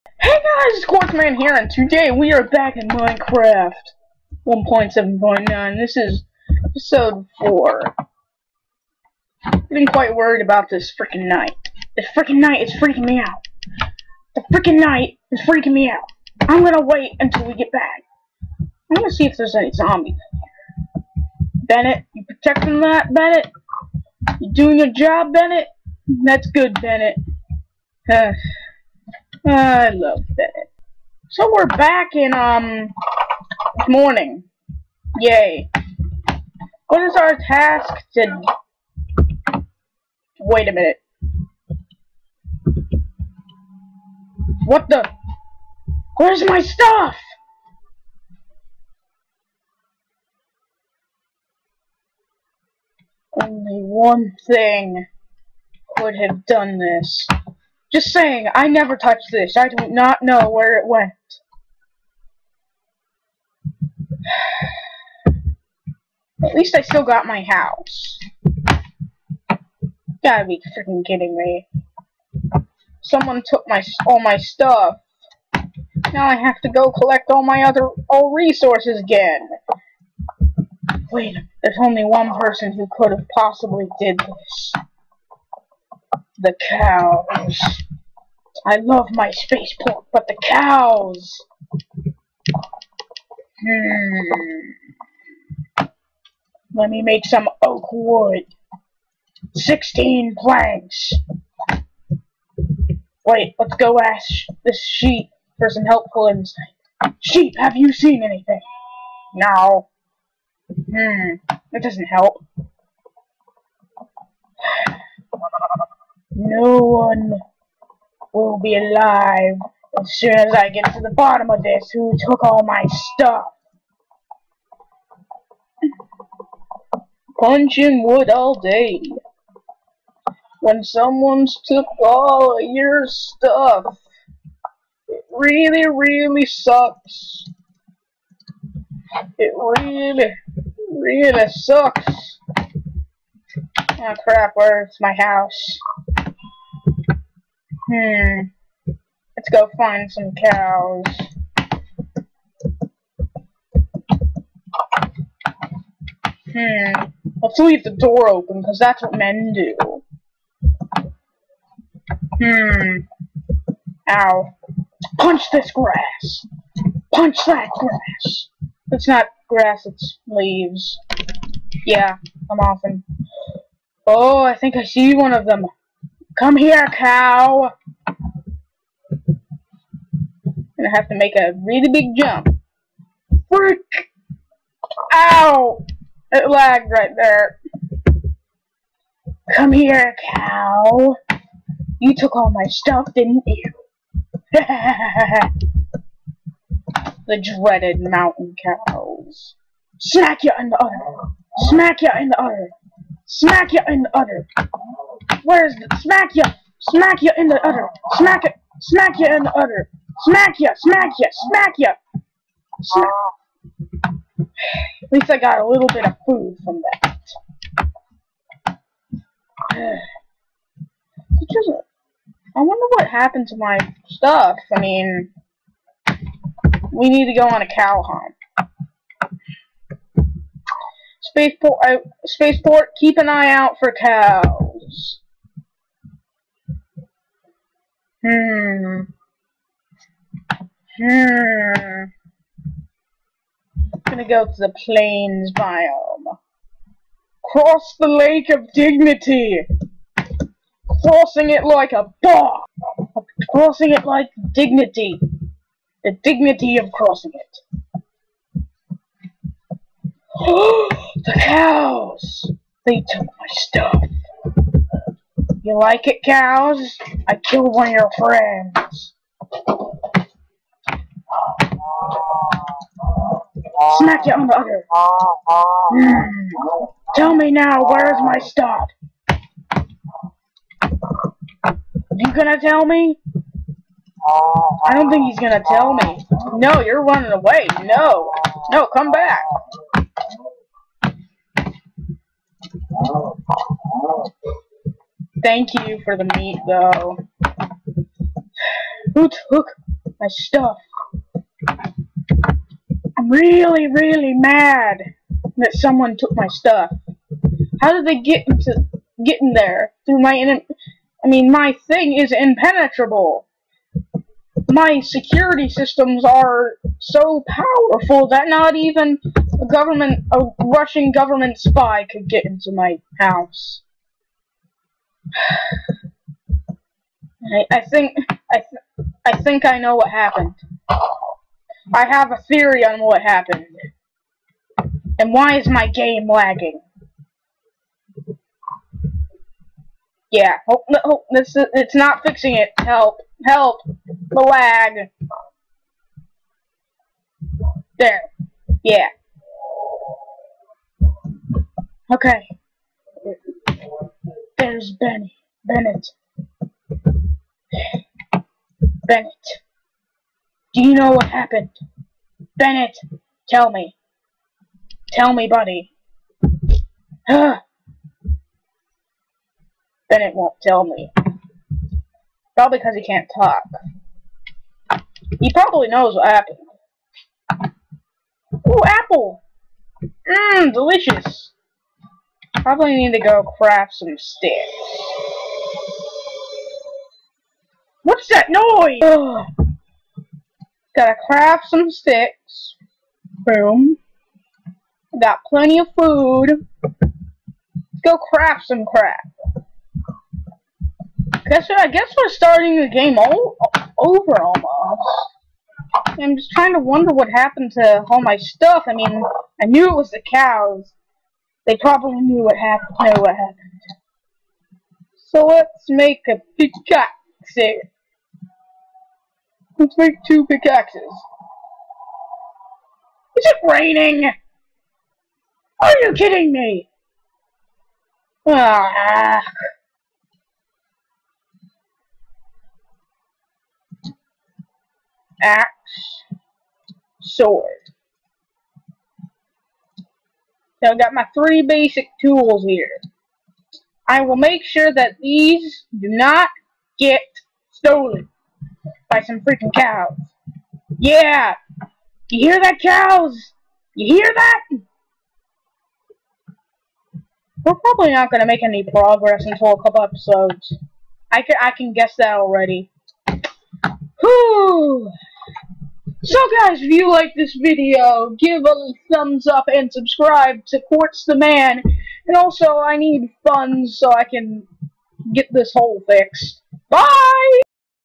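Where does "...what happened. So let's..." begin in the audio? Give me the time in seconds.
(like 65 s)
413 s.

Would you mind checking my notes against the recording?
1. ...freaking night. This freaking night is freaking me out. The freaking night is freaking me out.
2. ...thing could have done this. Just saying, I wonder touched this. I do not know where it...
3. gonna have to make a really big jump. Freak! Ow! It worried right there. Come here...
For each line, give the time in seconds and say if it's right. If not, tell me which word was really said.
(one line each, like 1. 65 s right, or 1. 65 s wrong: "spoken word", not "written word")
1. 10 s right
2. 54 s wrong: "never", not "wonder"
3. 180 s wrong: "lagged", not "worried".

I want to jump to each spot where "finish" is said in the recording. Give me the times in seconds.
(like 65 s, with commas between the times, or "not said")
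not said.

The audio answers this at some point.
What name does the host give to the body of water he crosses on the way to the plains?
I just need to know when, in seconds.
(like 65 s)
248 s.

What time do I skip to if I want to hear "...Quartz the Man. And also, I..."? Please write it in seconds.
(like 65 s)
470 s.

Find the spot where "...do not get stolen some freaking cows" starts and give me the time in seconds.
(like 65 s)
445 s.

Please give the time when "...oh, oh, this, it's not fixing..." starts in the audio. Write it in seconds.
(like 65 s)
340 s.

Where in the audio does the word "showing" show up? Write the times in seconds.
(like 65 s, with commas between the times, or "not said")
not said.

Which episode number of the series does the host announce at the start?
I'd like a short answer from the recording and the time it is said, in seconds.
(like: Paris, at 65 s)
4, at 6 s.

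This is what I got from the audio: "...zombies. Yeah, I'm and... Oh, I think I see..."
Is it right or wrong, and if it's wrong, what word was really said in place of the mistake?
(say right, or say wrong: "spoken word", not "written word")
wrong: "leaves", not "zombies".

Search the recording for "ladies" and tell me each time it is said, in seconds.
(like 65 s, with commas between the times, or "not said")
not said.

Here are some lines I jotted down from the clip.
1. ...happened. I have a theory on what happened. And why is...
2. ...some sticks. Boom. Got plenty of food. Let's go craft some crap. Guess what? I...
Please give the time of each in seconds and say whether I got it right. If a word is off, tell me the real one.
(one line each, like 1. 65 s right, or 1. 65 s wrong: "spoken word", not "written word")
1. 330 s right
2. 391 s right.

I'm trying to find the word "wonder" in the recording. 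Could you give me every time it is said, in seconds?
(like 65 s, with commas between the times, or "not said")
222 s, 406 s.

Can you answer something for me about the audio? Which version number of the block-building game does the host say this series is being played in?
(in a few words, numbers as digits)
1.7.9.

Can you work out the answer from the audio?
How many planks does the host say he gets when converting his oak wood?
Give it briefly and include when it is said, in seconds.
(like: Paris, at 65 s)
16, at 99 s.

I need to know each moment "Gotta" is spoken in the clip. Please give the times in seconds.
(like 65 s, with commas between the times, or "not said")
70 s, 390 s.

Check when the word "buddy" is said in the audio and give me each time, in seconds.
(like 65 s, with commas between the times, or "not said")
365 s.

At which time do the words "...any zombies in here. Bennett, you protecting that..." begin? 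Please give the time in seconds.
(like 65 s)
19 s.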